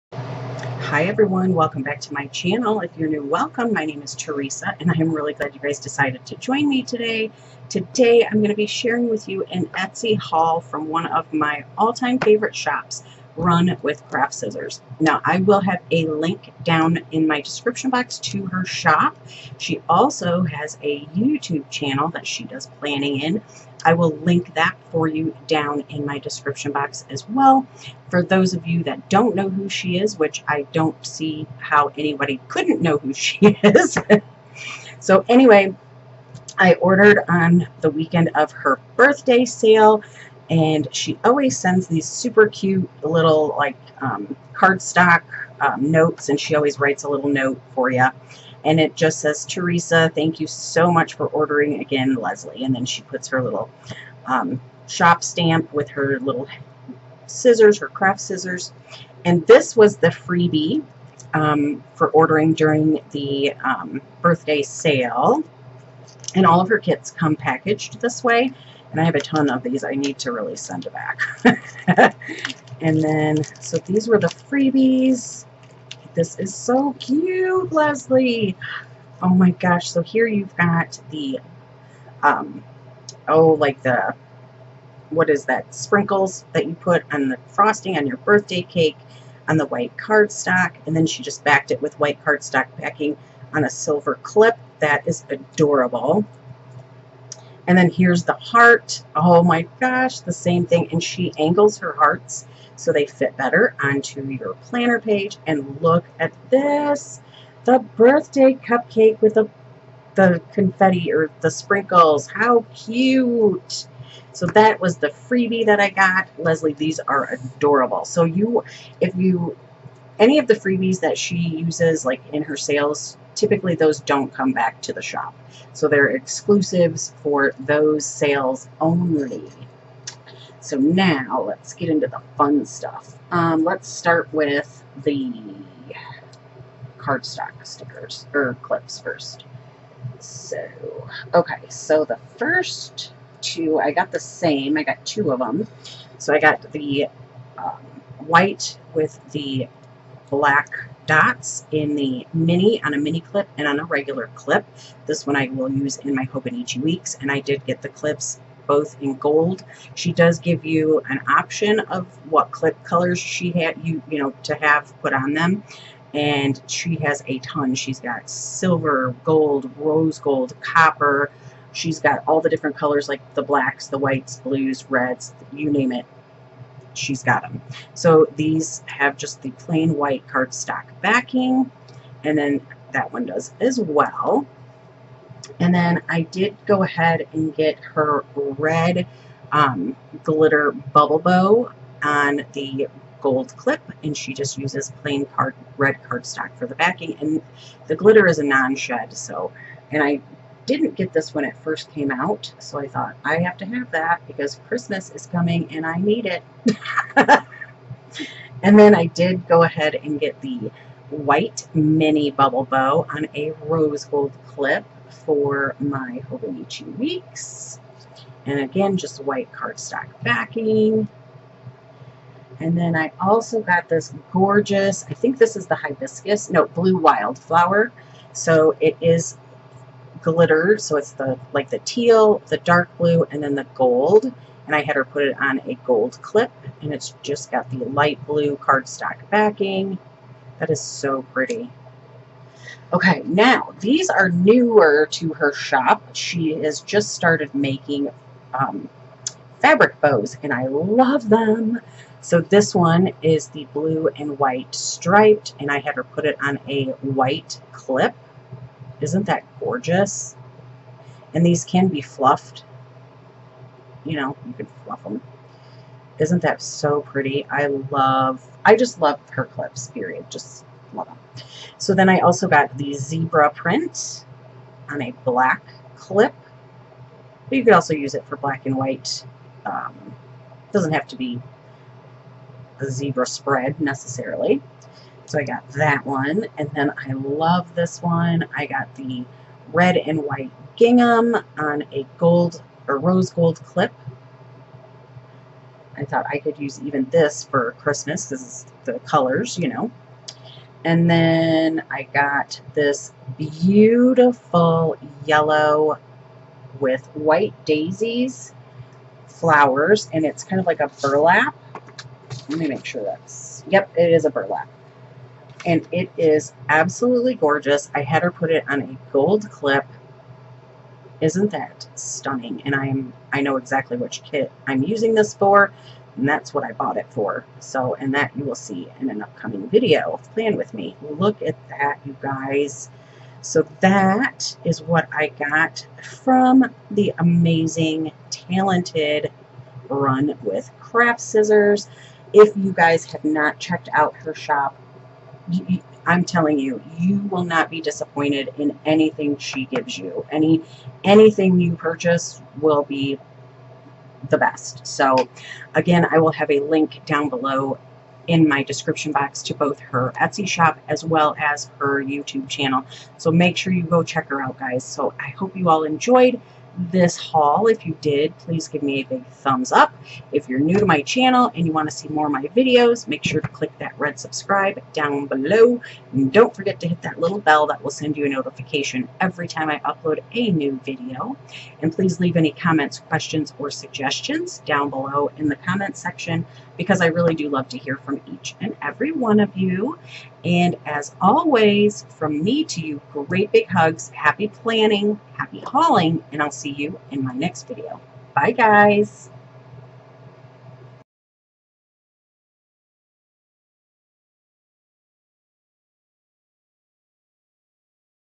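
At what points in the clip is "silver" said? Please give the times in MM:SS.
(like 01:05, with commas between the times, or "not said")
01:33, 02:48.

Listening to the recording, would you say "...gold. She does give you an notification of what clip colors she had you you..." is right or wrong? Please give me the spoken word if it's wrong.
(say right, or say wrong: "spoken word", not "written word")
wrong: "option", not "notification".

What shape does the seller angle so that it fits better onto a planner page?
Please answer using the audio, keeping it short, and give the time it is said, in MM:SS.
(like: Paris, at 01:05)
Hearts, at 01:41.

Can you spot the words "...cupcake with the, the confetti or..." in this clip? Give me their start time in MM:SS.
01:48.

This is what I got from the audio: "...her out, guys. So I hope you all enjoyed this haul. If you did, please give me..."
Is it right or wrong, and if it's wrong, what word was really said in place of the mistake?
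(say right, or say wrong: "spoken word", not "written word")
right.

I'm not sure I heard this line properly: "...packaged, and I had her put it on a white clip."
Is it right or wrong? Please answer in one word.
wrong.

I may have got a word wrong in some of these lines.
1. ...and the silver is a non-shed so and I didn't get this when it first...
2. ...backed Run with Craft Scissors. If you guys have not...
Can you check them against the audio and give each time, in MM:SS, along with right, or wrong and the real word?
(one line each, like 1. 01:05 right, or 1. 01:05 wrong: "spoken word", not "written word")
1. 03:17 wrong: "glitter", not "silver"
2. 05:38 wrong: "talented", not "backed".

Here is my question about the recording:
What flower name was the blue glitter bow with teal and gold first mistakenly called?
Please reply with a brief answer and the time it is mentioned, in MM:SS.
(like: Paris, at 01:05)
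Hibiscus, at 03:45.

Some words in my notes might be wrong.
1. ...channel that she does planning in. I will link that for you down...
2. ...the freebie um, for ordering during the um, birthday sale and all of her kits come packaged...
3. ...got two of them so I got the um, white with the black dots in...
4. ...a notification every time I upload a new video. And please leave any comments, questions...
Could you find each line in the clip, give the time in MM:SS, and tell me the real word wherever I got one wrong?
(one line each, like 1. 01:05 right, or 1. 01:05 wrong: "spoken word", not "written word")
1. 00:21 right
2. 00:59 right
3. 02:24 right
4. 06:18 right.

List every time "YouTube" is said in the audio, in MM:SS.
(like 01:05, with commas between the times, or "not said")
00:21, 06:02.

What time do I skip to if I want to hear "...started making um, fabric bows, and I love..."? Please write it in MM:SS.
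04:07.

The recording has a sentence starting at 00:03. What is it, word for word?
My name is Teresa and I'm really glad you guys decided to join me today.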